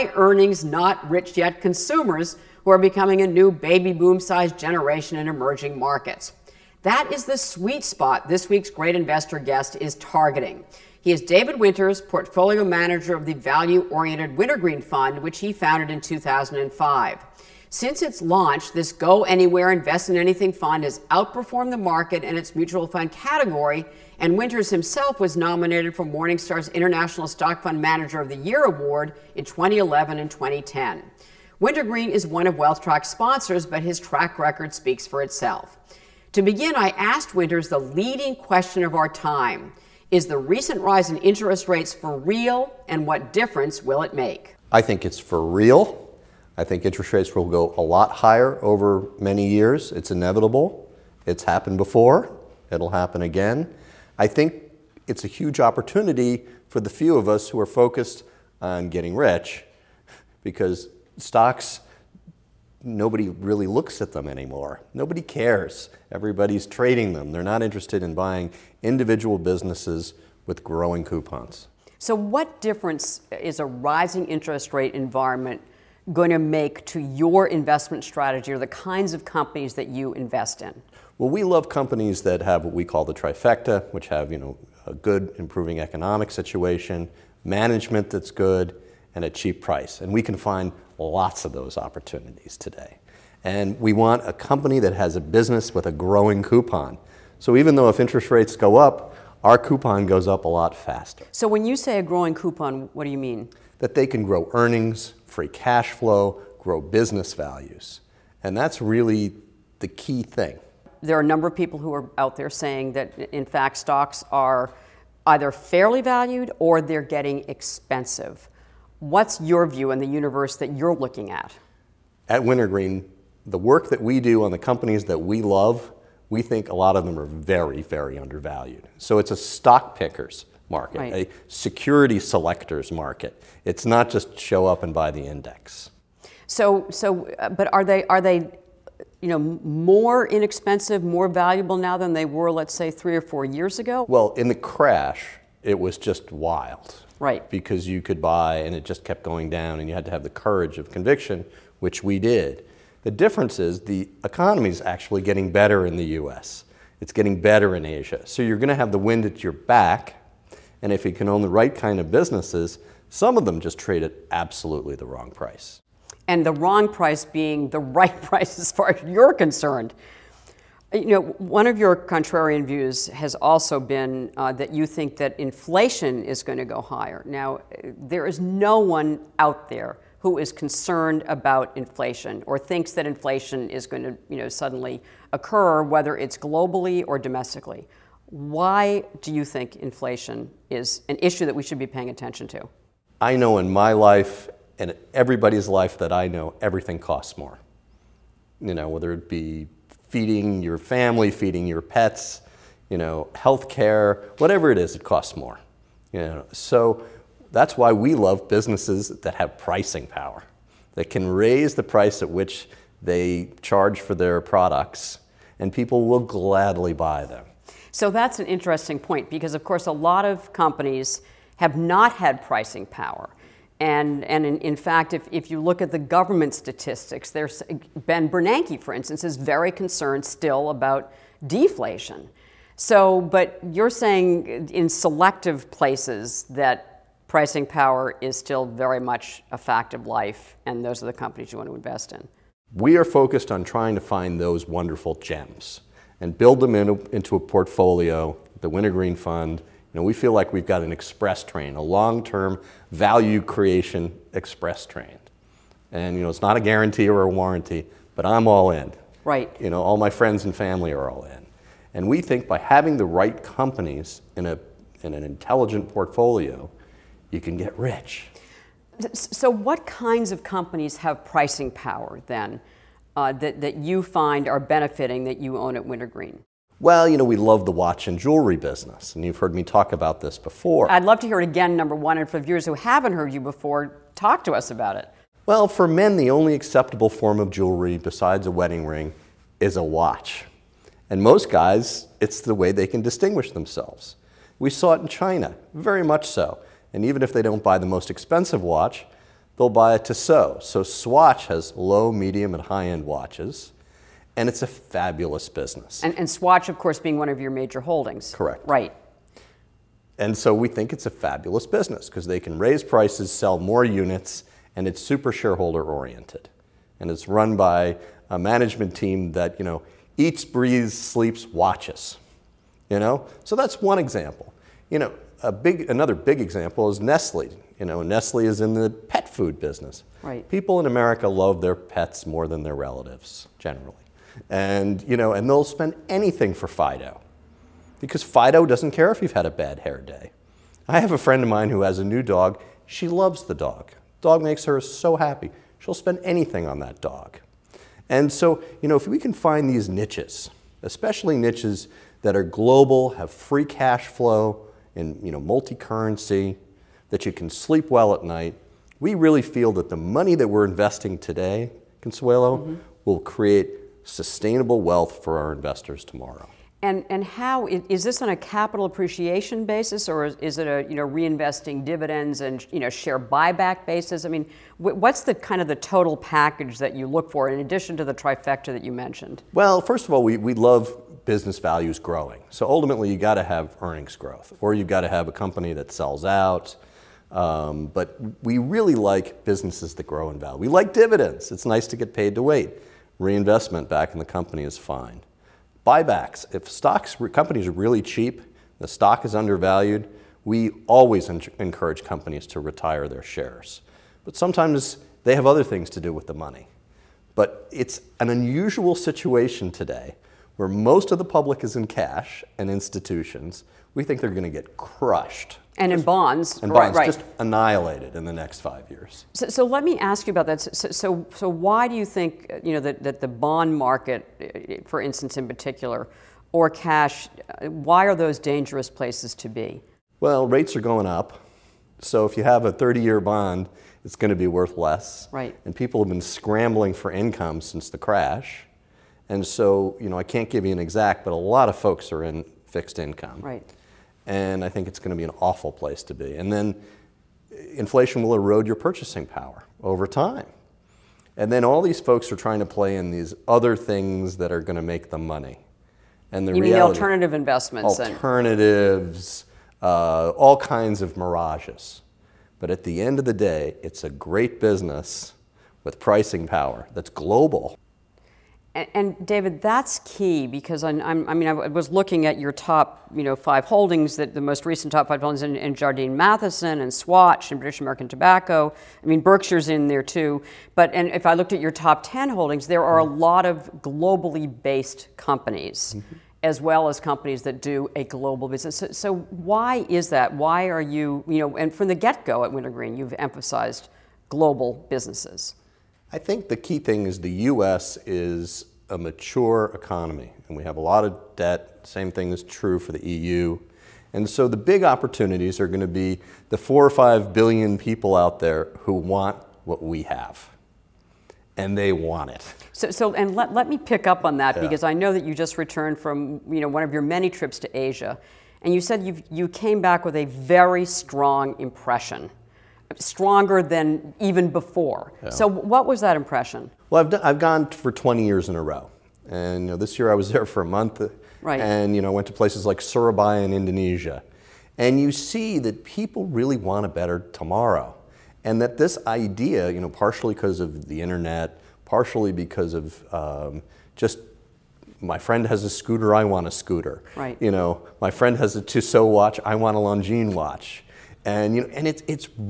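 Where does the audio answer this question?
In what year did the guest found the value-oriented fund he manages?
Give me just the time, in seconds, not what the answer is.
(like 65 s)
16 s.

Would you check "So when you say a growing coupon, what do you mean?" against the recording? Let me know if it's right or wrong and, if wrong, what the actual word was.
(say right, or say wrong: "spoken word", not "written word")
right.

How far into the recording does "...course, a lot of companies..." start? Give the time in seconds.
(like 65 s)
219 s.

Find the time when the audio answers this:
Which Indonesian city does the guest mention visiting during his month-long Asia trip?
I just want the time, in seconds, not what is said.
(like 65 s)
532 s.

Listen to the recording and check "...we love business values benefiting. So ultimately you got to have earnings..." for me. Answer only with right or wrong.
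wrong.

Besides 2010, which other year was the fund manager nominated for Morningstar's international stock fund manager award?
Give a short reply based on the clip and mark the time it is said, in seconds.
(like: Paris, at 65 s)
2011, at 29 s.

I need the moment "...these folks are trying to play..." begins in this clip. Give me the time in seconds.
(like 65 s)
451 s.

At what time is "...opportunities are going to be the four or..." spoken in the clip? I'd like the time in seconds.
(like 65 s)
504 s.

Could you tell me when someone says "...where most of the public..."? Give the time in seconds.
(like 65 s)
410 s.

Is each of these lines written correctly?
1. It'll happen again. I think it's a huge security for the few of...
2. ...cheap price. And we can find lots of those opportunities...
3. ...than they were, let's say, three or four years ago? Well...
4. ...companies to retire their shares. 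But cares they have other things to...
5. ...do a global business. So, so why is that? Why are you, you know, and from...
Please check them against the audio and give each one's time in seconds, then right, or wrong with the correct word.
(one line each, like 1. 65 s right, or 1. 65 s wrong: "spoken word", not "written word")
1. 52 s wrong: "opportunity", not "security"
2. 89 s right
3. 141 s right
4. 402 s wrong: "sometimes", not "cares"
5. 487 s right.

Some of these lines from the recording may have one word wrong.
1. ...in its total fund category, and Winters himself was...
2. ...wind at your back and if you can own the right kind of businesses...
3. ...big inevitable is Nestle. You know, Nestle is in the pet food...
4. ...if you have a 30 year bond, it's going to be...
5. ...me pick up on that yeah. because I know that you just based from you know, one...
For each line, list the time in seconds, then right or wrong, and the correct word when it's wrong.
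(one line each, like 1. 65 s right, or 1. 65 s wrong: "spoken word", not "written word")
1. 22 s wrong: "mutual", not "total"
2. 158 s right
3. 326 s wrong: "example", not "inevitable"
4. 432 s right
5. 513 s wrong: "returned", not "based".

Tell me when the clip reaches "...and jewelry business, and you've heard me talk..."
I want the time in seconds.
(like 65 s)
278 s.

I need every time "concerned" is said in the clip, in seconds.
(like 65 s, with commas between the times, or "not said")
169 s, 180 s, 229 s.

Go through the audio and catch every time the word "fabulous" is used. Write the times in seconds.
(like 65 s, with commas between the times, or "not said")
304 s, 311 s.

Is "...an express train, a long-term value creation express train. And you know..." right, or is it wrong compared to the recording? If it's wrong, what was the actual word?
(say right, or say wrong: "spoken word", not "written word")
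right.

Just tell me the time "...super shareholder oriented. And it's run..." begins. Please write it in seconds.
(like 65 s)
315 s.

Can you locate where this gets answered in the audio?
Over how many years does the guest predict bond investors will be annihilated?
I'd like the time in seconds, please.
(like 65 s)
418 s.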